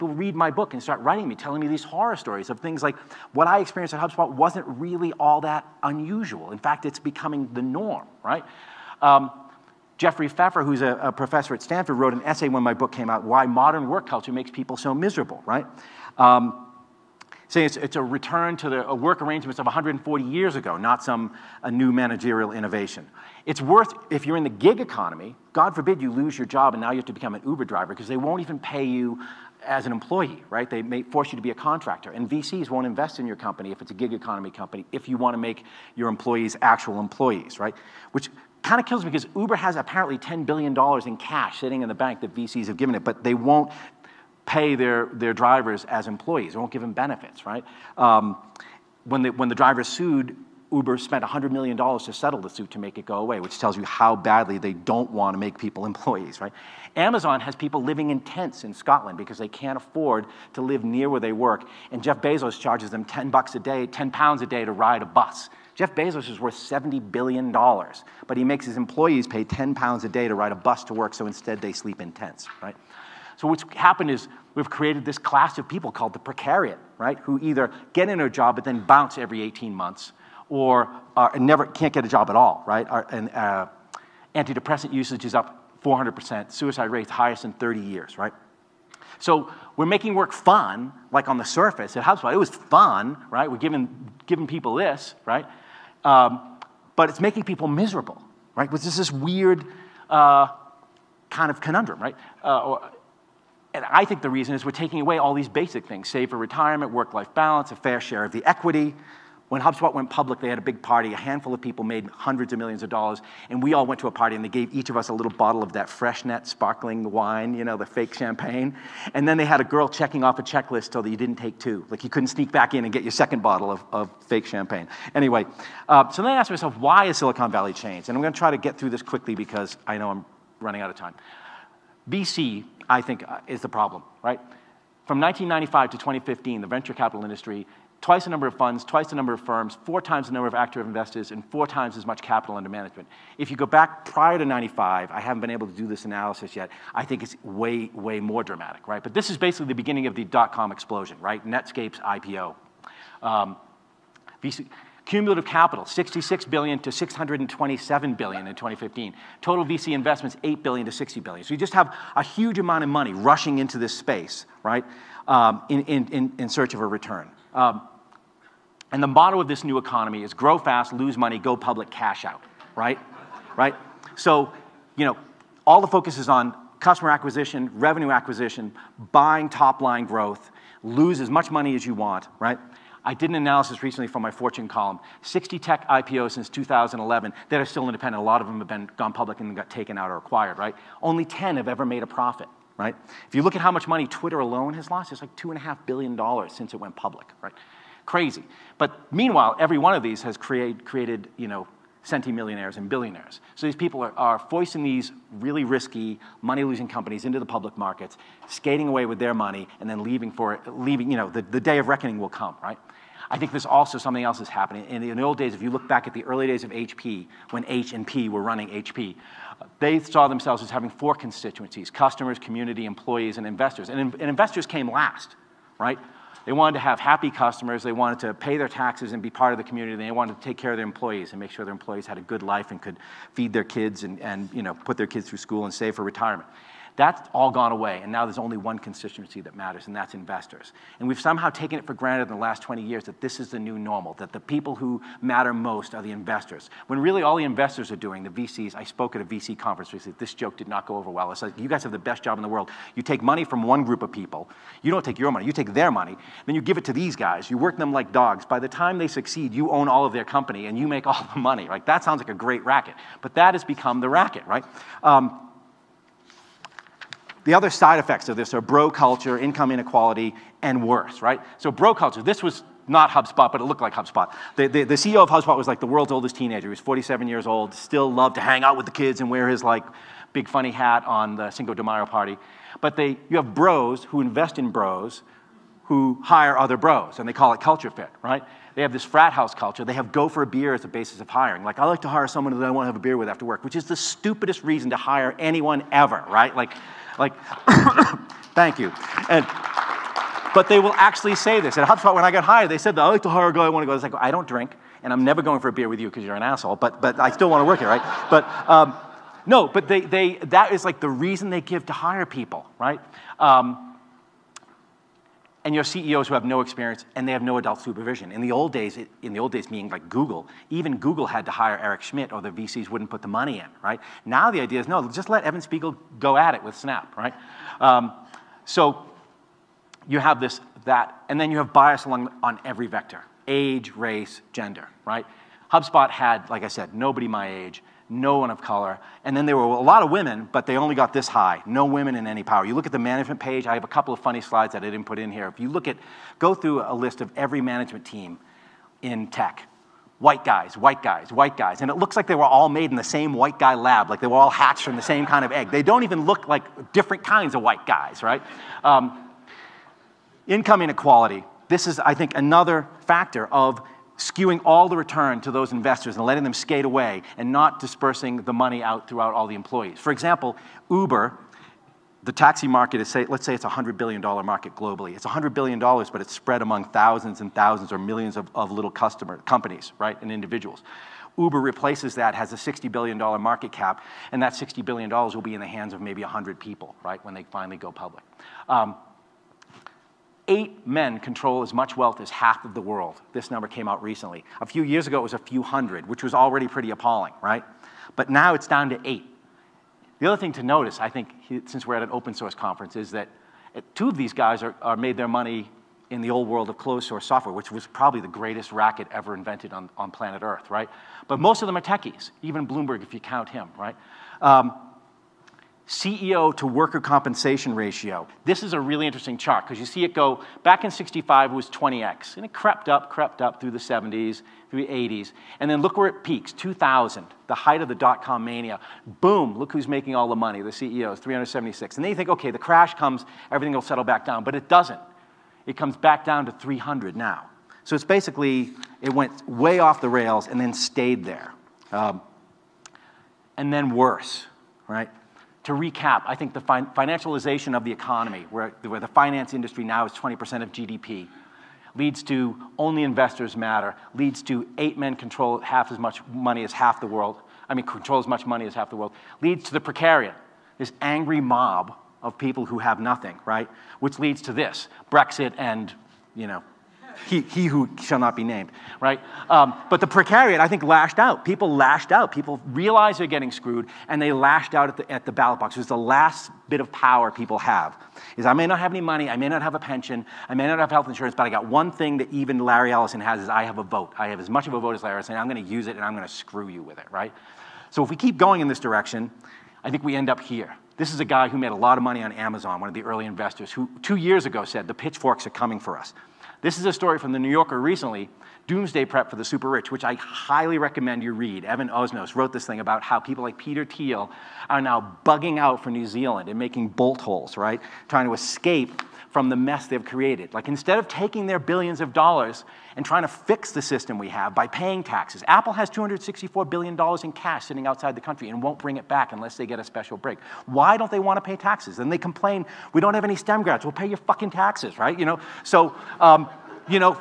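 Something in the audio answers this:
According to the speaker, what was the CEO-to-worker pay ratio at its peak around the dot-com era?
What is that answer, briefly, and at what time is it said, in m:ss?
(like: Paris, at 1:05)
376, at 7:11.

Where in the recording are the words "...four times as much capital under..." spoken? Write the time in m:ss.
2:21.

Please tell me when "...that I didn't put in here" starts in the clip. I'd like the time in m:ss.
5:44.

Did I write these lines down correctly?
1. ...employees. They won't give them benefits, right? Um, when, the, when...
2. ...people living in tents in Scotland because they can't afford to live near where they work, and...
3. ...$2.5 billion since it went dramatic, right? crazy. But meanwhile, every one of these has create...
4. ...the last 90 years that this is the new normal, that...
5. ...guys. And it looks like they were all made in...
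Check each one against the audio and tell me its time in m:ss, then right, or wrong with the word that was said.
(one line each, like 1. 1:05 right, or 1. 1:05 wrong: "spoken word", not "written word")
1. 0:46 right
2. 0:57 right
3. 3:15 wrong: "public", not "dramatic"
4. 4:02 wrong: "20", not "90"
5. 5:51 right.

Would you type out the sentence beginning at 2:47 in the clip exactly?
Um, and the motto of this new economy is grow fast, lose money, go public, cash out, right?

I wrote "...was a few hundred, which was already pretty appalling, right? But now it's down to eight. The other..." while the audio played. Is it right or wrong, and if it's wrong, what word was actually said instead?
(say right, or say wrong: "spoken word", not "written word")
right.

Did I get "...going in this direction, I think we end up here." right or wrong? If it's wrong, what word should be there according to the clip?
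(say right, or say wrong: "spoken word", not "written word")
right.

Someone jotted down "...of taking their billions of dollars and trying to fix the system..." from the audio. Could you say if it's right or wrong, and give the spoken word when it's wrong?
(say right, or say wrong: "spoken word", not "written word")
right.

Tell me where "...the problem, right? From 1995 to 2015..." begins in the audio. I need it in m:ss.
2:13.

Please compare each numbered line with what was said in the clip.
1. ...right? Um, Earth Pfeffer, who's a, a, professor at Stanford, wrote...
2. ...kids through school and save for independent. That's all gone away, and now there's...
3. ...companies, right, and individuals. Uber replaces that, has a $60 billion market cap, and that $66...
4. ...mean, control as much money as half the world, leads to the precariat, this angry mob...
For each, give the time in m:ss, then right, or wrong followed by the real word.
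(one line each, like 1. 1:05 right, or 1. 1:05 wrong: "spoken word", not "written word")
1. 0:08 wrong: "Jeffrey", not "Earth"
2. 3:55 wrong: "retirement", not "independent"
3. 6:19 wrong: "60", not "66"
4. 7:37 right.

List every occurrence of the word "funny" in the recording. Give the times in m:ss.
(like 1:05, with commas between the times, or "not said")
4:40, 5:44.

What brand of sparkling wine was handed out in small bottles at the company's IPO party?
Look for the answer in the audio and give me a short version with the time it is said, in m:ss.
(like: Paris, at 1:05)
Freixenet, at 1:55.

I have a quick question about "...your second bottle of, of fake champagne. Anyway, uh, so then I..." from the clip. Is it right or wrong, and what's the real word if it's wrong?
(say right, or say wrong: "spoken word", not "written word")
right.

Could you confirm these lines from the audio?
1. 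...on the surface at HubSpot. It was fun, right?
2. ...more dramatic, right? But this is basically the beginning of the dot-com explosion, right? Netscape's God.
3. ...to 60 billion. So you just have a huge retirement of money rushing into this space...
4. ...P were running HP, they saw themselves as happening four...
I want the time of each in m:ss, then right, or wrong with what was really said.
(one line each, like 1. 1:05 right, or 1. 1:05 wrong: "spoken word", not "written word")
1. 1:31 right
2. 2:28 wrong: "IPO", not "God"
3. 2:40 wrong: "amount", not "retirement"
4. 3:38 wrong: "having", not "happening".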